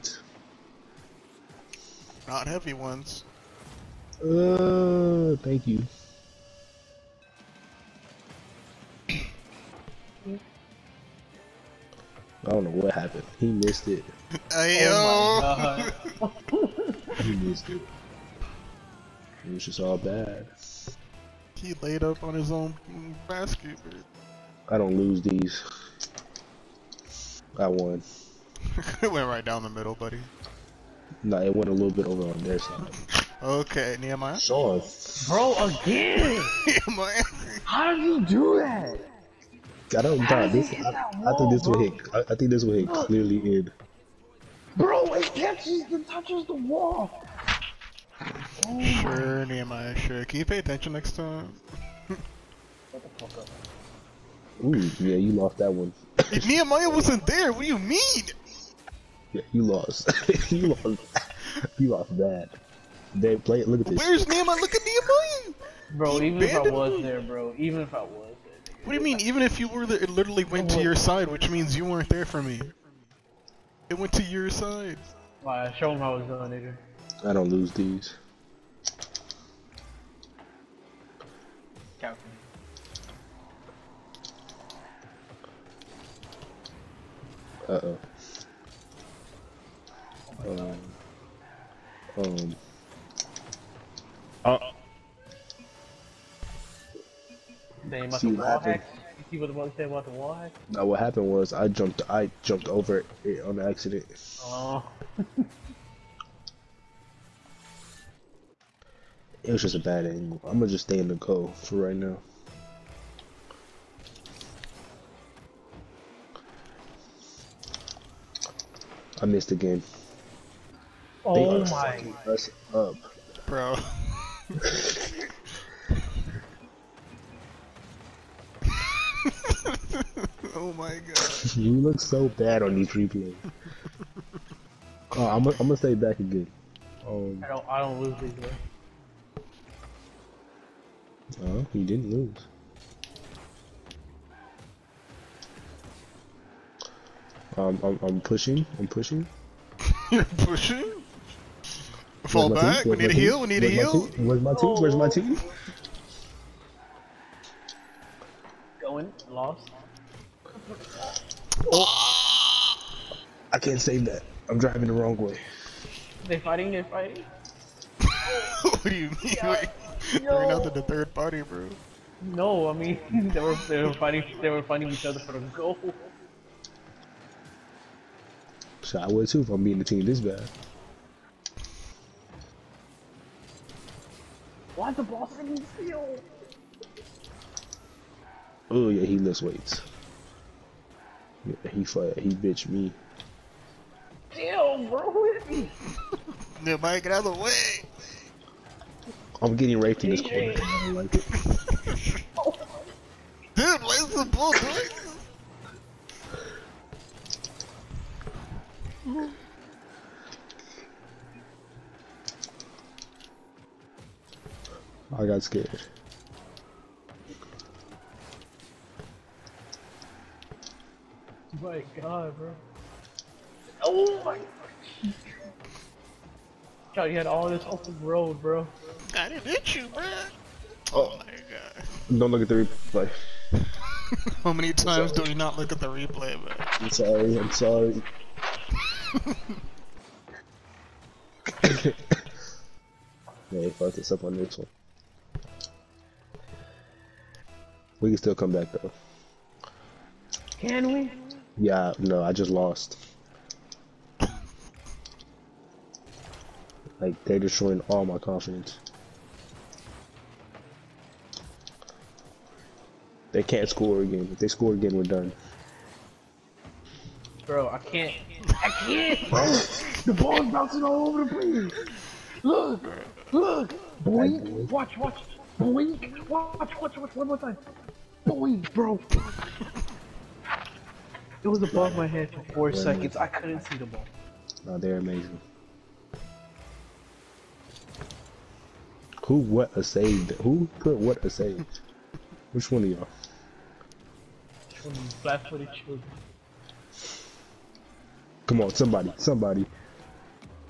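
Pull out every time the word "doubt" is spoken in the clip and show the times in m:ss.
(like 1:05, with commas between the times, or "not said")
0:40.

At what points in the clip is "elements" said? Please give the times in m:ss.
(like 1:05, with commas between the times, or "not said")
not said.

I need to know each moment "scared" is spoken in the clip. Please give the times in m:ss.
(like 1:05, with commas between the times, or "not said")
3:35.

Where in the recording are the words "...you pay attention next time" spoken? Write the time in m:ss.
0:50.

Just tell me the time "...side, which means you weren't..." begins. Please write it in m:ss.
1:10.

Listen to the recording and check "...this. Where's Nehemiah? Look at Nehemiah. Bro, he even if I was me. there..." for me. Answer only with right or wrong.
right.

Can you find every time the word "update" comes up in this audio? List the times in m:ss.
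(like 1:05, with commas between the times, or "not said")
not said.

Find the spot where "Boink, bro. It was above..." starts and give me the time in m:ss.
4:38.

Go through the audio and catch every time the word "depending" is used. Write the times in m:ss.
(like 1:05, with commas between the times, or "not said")
not said.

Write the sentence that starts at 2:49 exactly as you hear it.
Wait, they're not in the third party, bro.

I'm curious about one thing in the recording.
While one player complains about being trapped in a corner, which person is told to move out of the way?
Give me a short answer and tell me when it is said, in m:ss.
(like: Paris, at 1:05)
Mike, at 3:16.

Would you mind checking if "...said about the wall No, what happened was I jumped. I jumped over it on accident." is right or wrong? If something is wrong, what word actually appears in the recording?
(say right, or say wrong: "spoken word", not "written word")
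right.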